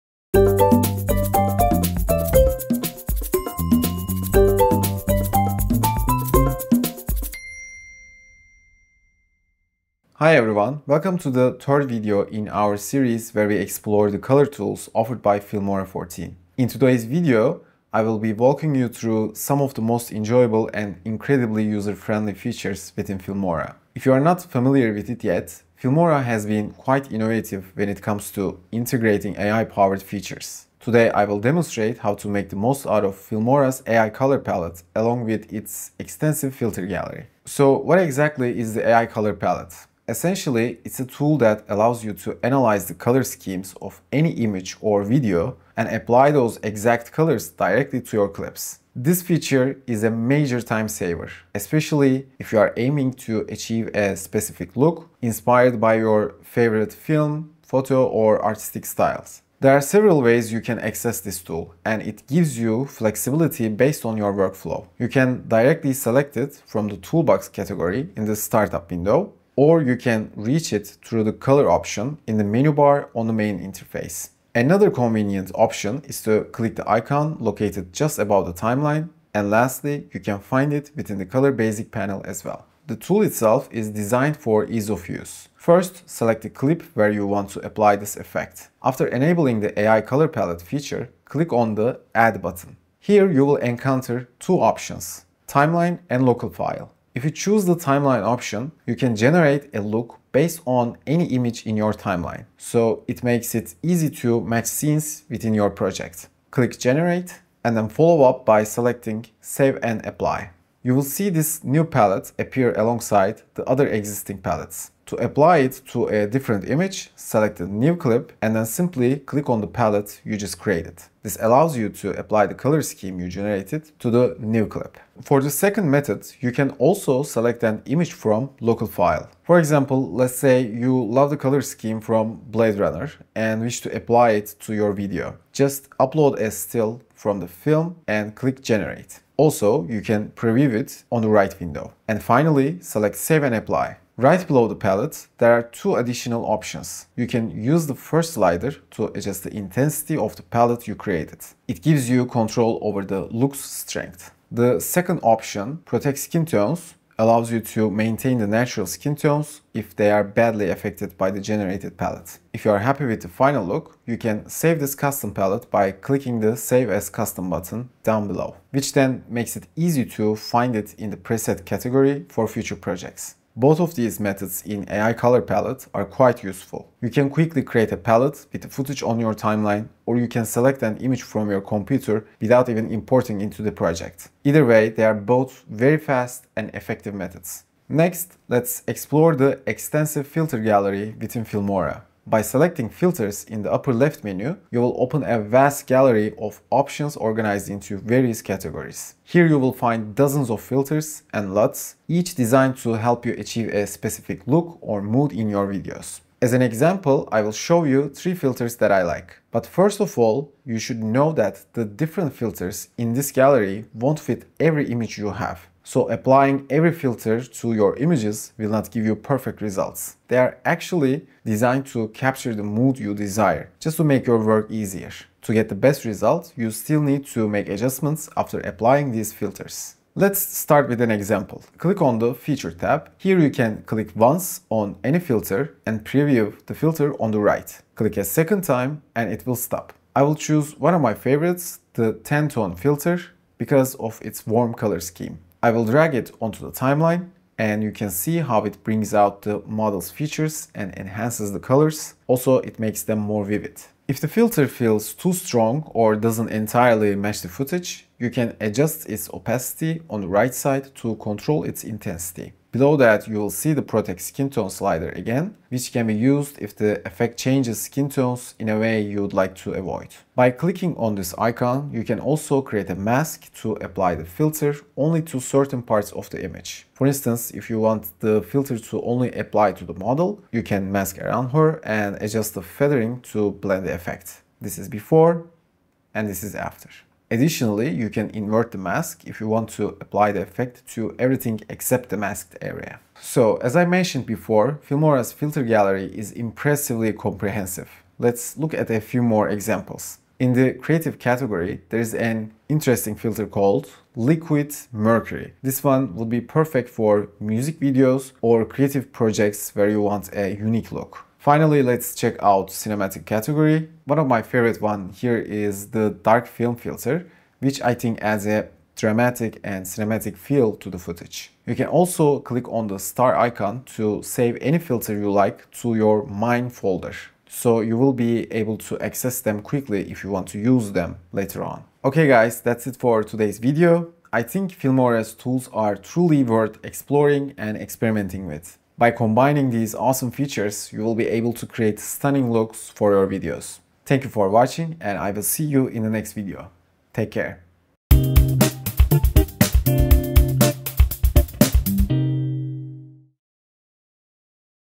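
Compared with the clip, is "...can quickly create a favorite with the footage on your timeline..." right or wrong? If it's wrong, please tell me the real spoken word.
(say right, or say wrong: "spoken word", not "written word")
wrong: "palette", not "favorite".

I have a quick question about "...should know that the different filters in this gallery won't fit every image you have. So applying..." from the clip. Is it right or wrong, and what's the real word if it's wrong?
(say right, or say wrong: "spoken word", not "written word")
right.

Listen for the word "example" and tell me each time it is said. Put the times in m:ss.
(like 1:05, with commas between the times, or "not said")
2:09, 3:26, 3:51, 4:59.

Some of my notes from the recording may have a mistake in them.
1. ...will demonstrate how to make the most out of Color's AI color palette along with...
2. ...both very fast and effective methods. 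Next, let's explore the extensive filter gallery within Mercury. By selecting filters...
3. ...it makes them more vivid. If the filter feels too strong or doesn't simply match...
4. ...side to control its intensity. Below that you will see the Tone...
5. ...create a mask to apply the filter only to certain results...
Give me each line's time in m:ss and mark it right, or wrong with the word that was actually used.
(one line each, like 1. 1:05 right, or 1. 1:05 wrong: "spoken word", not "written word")
1. 0:31 wrong: "Filmora", not "Color"
2. 3:05 wrong: "Filmora", not "Mercury"
3. 4:12 wrong: "entirely", not "simply"
4. 4:20 wrong: "Protect", not "Tone"
5. 4:32 wrong: "parts", not "results".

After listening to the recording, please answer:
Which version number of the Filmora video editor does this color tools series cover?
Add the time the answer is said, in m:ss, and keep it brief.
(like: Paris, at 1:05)
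14, at 0:15.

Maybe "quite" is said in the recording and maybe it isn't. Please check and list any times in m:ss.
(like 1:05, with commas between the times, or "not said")
0:26, 2:56.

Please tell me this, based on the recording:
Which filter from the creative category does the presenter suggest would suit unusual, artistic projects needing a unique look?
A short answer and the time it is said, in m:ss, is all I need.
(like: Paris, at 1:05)
Liquid Mercury, at 5:04.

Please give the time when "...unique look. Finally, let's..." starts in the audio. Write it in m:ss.
5:10.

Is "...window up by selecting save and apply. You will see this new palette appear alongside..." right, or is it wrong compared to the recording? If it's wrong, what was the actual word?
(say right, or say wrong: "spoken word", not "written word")
wrong: "follow", not "window".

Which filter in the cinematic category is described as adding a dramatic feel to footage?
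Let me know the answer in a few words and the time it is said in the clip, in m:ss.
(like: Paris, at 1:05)
Dark film, at 5:16.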